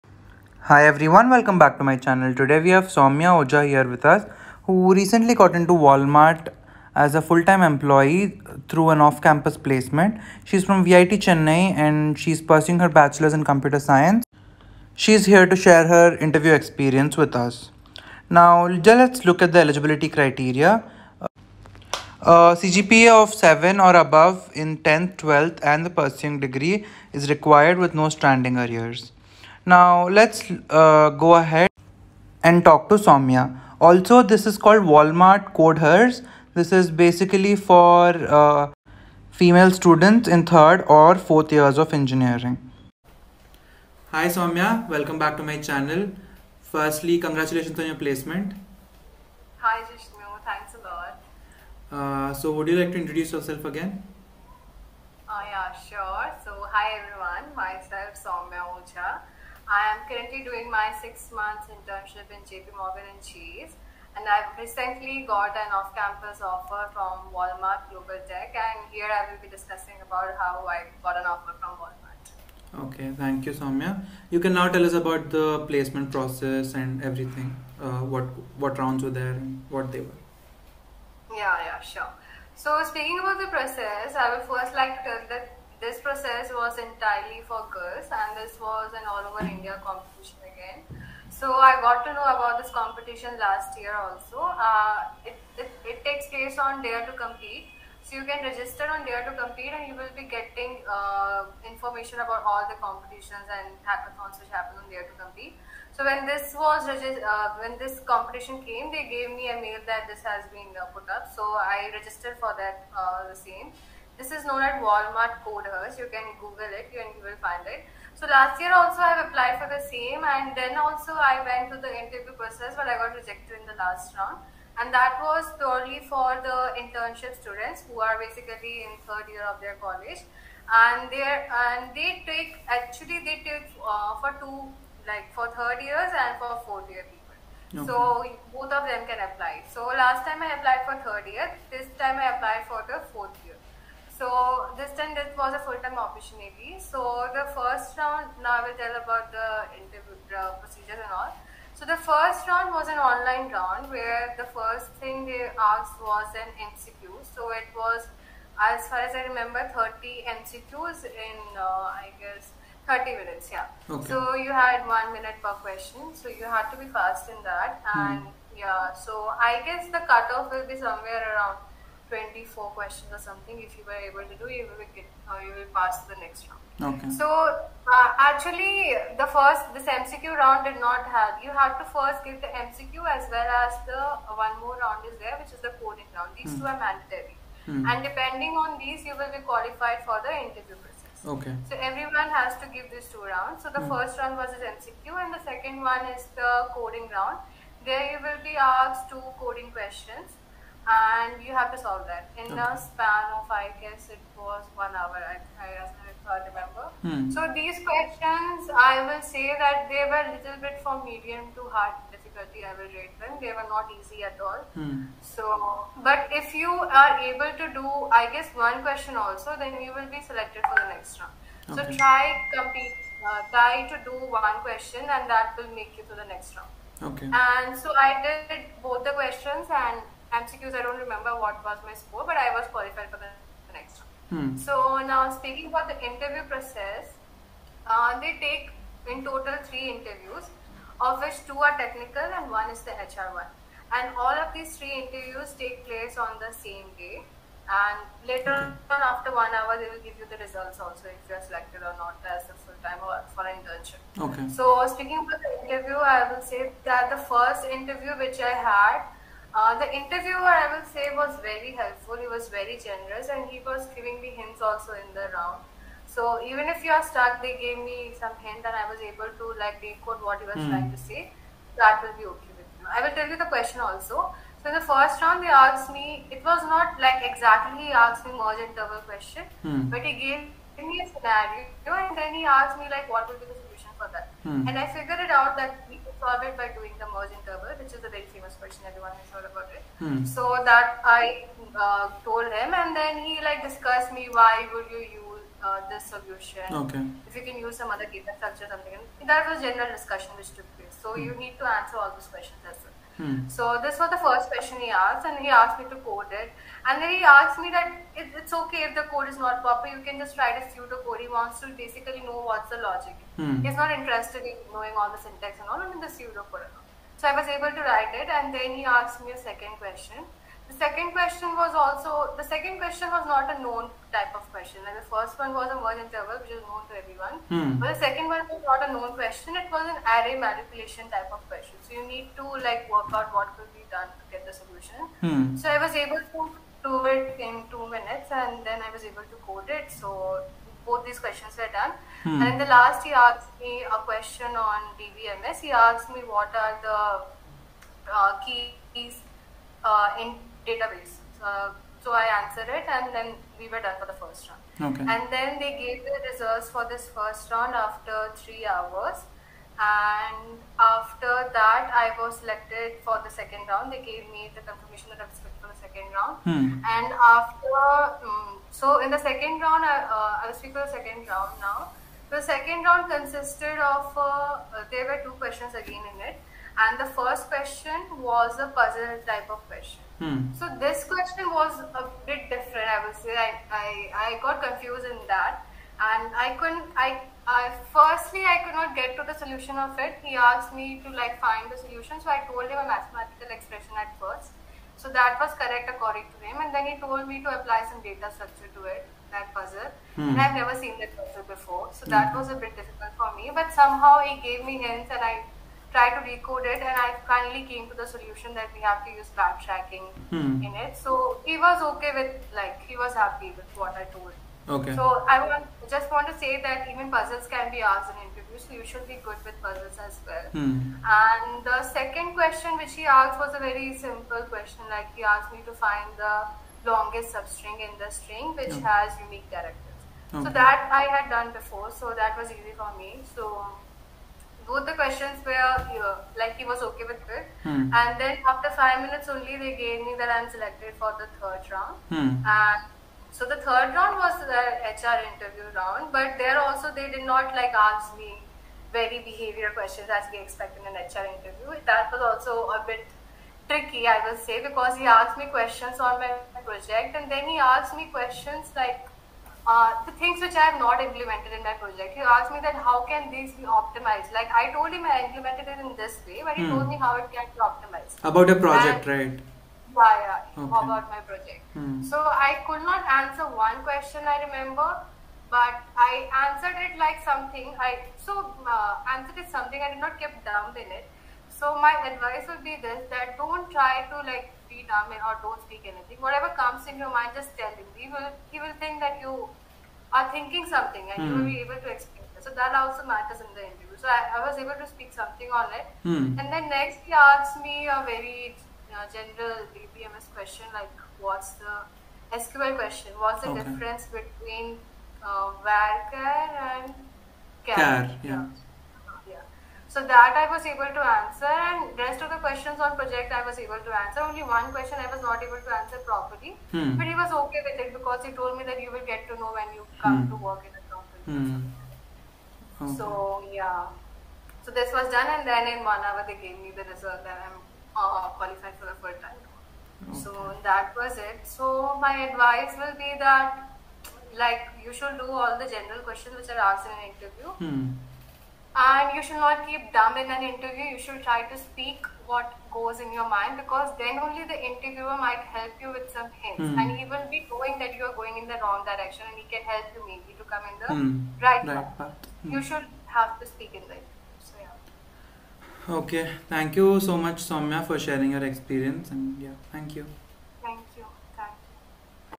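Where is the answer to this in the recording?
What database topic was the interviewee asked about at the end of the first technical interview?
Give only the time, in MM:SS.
05:48.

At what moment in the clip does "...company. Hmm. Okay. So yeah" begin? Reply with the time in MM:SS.
08:40.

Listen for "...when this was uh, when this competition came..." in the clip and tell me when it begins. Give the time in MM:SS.
01:46.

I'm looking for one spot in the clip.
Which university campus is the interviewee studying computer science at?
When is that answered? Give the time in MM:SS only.
00:10.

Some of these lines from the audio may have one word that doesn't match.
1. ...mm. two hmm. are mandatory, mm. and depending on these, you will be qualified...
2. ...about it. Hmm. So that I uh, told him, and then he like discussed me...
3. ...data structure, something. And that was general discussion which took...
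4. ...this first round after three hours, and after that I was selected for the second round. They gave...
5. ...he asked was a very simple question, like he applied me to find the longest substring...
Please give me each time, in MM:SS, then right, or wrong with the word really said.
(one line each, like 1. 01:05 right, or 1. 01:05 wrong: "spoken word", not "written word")
1. 03:06 right
2. 04:49 right
3. 04:58 right
4. 05:56 right
5. 07:02 wrong: "asked", not "applied".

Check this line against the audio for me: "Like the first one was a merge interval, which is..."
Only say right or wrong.
right.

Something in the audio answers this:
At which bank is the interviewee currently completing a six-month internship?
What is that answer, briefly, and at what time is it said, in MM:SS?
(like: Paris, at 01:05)
JP Morgan and Chase, at 01:02.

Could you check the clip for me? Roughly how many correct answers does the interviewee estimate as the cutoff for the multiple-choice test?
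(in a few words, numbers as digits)
24.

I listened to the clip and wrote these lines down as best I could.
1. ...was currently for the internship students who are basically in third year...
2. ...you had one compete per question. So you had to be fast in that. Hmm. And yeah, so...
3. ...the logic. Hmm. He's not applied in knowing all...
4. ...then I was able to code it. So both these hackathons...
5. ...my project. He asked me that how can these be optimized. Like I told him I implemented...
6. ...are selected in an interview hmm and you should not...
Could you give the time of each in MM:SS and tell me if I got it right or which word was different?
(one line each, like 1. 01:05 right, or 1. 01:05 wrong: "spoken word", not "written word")
1. 02:05 wrong: "purely", not "currently"
2. 02:44 wrong: "minute", not "compete"
3. 05:12 wrong: "interested", not "applied"
4. 05:38 wrong: "questions", not "hackathons"
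5. 07:41 right
6. 08:56 wrong: "asked", not "selected".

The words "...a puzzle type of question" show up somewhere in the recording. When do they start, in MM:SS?
06:18.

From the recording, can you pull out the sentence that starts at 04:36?
It was not like exactly he asked me merge interval question, mm.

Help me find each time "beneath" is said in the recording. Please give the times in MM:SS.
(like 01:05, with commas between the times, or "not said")
not said.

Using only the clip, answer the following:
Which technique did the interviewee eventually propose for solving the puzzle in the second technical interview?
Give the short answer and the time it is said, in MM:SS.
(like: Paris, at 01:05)
Backtracking, at 06:49.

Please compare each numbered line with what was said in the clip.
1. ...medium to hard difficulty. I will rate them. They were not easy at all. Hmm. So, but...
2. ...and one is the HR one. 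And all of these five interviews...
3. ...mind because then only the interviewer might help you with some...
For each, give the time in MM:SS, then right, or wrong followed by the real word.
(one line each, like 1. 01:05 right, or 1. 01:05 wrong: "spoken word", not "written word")
1. 03:31 right
2. 04:02 wrong: "three", not "five"
3. 09:03 right.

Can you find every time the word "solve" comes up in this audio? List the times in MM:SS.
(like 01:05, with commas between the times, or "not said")
03:21, 04:46.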